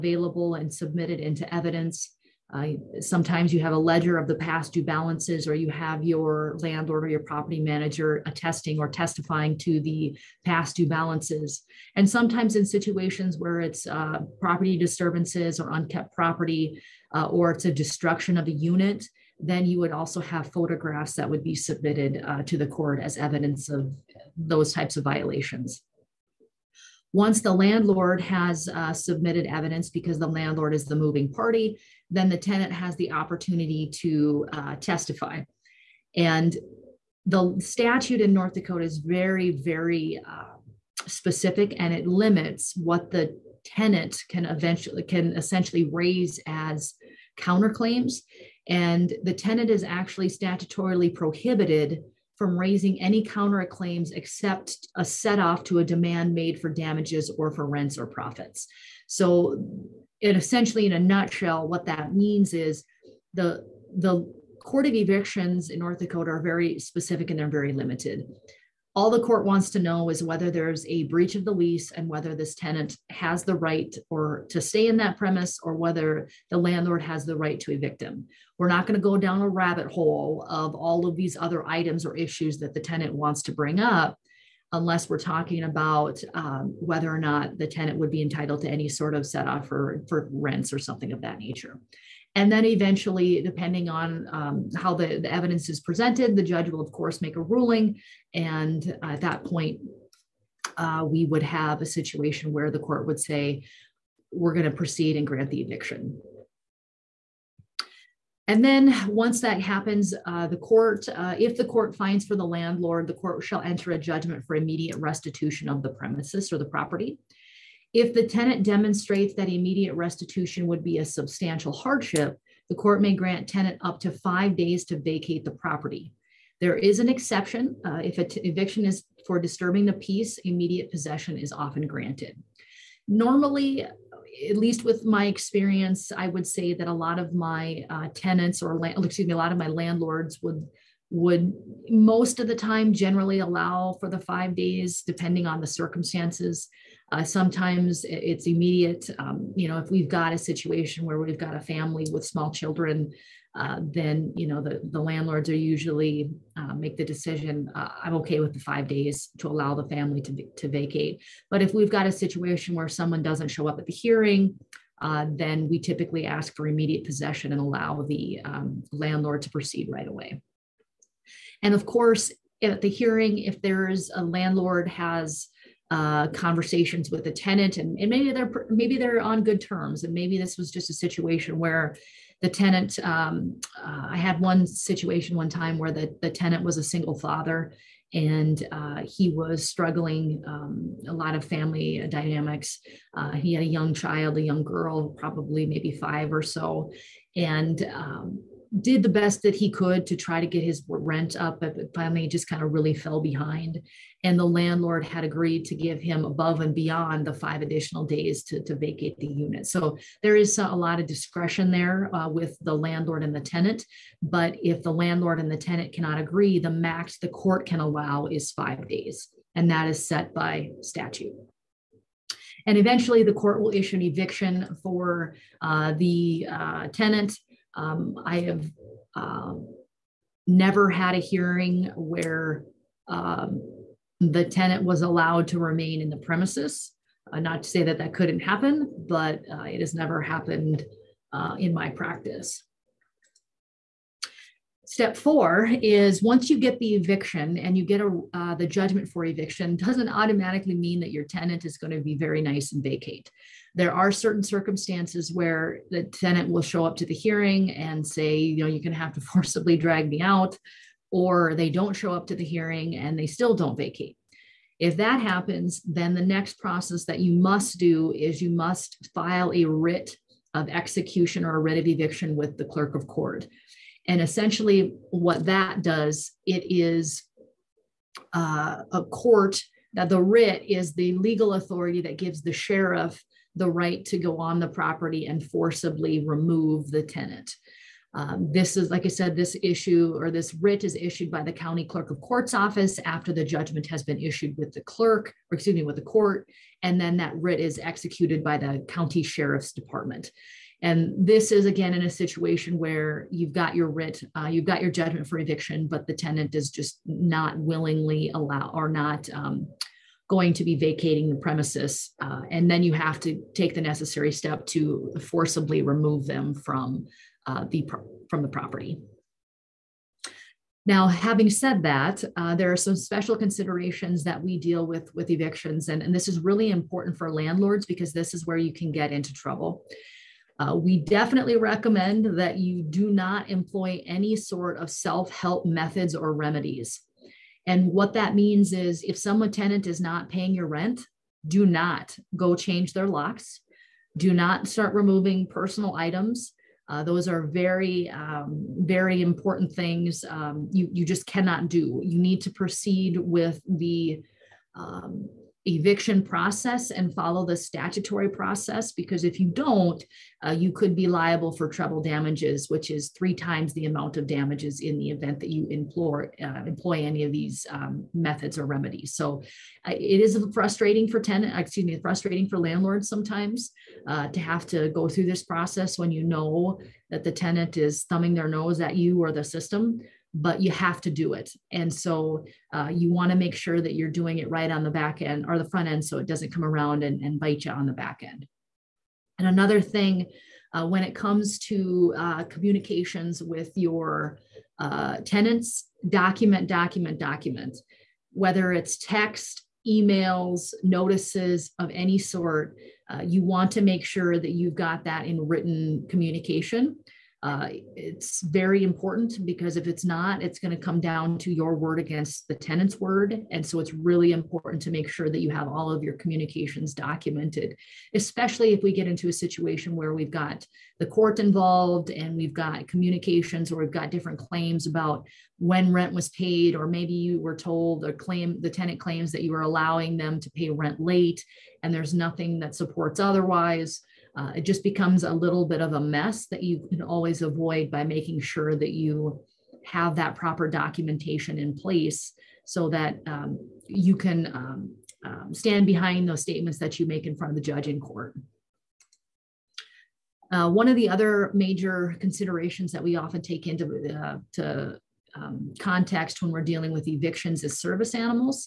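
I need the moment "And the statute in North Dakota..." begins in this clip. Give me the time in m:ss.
0:36.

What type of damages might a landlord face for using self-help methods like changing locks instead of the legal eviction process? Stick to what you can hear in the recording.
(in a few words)
Treble damages.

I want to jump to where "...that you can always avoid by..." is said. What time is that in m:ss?
7:16.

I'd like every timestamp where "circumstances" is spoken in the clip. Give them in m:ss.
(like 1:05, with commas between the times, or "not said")
2:25, 4:14.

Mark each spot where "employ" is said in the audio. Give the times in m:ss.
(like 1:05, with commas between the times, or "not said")
5:33, 6:06.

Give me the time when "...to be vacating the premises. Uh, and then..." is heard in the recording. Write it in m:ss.
5:10.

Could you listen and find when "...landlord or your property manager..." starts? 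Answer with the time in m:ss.
0:06.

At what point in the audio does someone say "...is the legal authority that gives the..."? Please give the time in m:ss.
4:40.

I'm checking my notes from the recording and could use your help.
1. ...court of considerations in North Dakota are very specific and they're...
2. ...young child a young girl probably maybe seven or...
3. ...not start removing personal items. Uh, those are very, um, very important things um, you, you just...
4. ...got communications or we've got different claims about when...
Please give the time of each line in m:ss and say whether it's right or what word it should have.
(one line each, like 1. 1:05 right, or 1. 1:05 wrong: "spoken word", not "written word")
1. 1:04 wrong: "evictions", not "considerations"
2. 3:13 wrong: "five", not "seven"
3. 5:44 right
4. 7:02 right.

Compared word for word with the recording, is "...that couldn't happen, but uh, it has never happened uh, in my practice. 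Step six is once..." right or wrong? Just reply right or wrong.
wrong.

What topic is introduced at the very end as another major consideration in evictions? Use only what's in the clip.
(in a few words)
Service animals.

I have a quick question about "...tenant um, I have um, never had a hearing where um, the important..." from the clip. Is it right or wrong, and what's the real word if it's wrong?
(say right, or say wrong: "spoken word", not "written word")
wrong: "tenant", not "important".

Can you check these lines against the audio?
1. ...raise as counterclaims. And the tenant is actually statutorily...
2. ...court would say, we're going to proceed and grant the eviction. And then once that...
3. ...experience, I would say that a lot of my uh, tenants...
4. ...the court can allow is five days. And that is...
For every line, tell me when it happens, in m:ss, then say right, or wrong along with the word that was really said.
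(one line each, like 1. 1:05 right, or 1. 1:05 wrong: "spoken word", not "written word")
1. 0:45 right
2. 1:42 right
3. 2:15 right
4. 3:37 right.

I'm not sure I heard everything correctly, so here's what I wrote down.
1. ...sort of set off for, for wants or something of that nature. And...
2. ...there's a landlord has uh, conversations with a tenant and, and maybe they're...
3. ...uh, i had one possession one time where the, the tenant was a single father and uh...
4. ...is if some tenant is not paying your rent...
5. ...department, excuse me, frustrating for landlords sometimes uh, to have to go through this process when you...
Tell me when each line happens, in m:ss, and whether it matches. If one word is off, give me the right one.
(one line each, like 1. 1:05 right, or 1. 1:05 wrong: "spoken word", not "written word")
1. 1:28 wrong: "rents", not "wants"
2. 2:53 right
3. 3:03 wrong: "situation", not "possession"
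4. 5:38 right
5. 6:11 wrong: "tenant", not "department".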